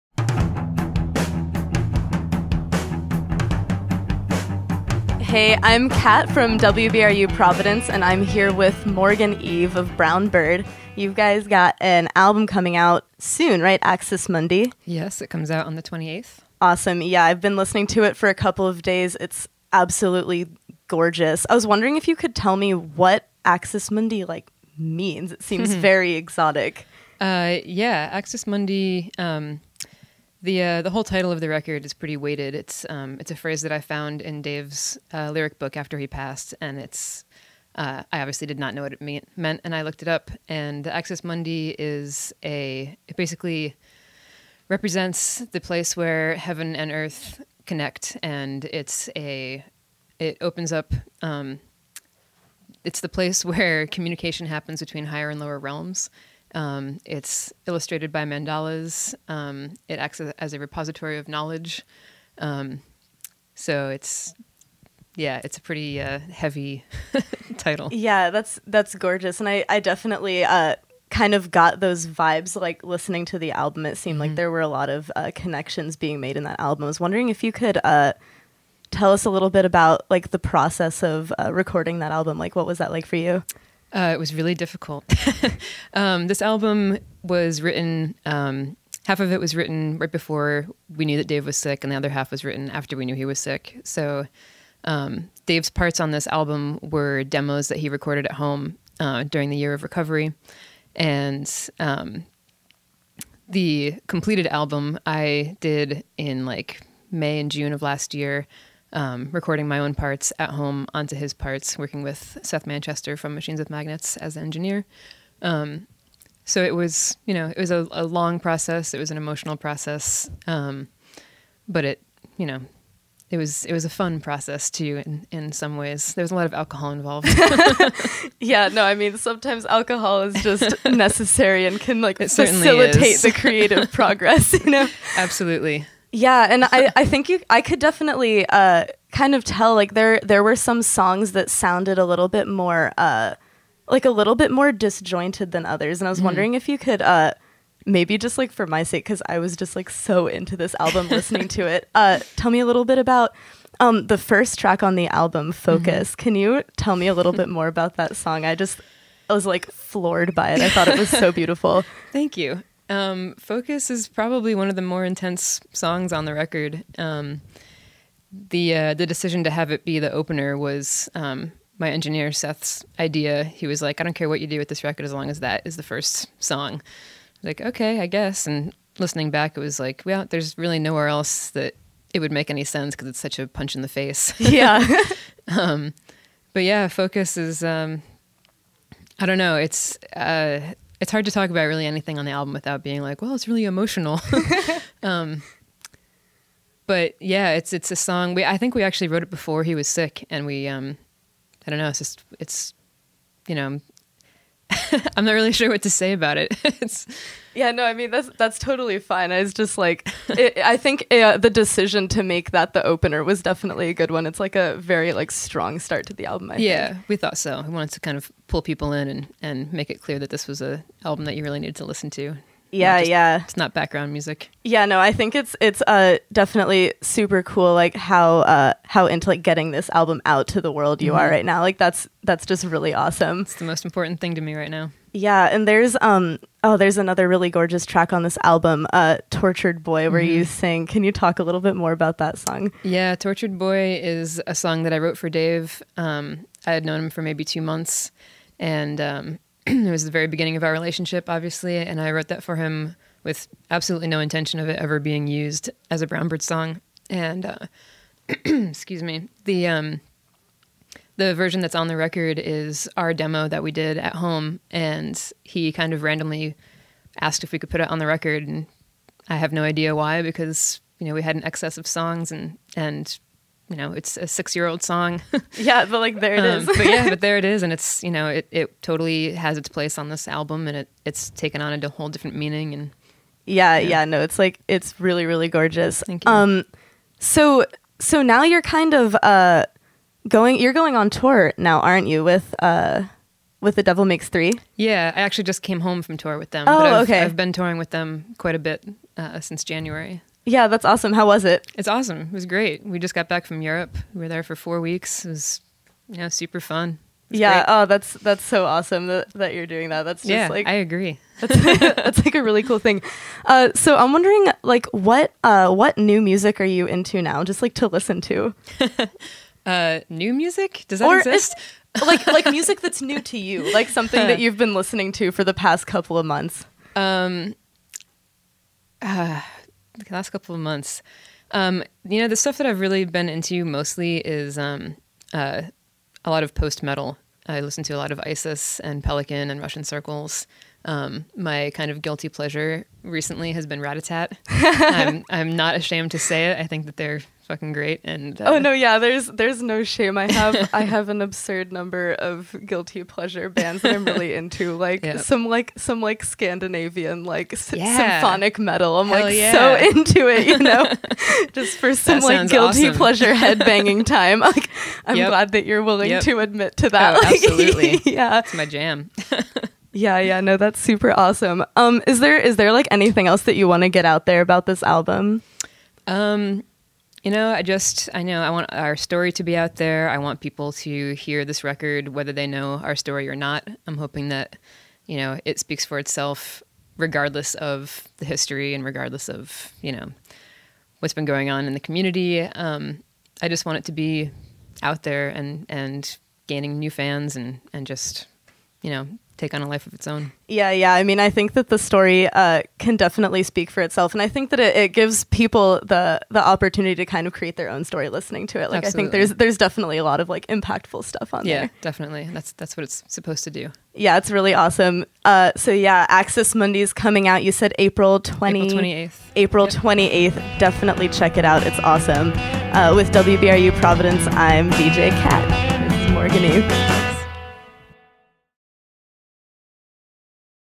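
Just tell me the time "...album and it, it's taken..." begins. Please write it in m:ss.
4:40.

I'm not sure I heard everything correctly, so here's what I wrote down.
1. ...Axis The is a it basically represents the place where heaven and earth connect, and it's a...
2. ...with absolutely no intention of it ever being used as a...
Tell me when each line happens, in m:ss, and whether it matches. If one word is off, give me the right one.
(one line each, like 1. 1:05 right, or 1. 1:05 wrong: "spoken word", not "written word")
1. 0:40 wrong: "Mundi", not "The"
2. 4:13 right.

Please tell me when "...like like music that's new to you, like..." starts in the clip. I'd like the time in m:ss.
5:22.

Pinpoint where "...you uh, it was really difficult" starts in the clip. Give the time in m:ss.
1:23.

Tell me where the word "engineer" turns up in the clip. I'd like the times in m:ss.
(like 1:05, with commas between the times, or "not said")
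1:54, 2:51.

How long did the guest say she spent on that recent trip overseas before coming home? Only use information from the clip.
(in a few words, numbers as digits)
4 weeks.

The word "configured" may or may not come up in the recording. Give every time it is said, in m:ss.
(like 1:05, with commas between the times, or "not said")
not said.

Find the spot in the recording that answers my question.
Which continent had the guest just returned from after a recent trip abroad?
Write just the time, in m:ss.
5:03.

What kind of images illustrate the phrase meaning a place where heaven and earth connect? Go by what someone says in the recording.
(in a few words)
Mandalas.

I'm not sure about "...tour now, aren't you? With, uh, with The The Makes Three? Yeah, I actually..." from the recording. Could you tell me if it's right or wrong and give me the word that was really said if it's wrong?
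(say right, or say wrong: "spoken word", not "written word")
wrong: "Devil", not "The".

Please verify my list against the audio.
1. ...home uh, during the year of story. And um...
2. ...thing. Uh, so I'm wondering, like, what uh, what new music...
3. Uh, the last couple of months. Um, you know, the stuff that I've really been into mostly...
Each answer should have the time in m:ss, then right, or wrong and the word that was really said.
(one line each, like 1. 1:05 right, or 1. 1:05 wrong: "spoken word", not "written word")
1. 1:38 wrong: "recovery", not "story"
2. 5:12 right
3. 5:29 right.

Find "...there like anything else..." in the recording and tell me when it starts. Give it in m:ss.
6:12.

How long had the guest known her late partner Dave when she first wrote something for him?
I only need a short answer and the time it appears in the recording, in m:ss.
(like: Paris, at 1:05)
2 months, at 4:07.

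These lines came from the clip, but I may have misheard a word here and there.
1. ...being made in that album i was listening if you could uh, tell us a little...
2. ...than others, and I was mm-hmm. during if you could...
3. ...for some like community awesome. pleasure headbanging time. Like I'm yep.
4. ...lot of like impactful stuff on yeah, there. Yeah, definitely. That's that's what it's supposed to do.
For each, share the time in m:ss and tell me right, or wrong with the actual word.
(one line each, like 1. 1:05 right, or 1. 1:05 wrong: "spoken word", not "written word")
1. 1:15 wrong: "wondering", not "listening"
2. 2:25 wrong: "wondering", not "during"
3. 6:01 wrong: "guilty", not "community"
4. 6:50 right.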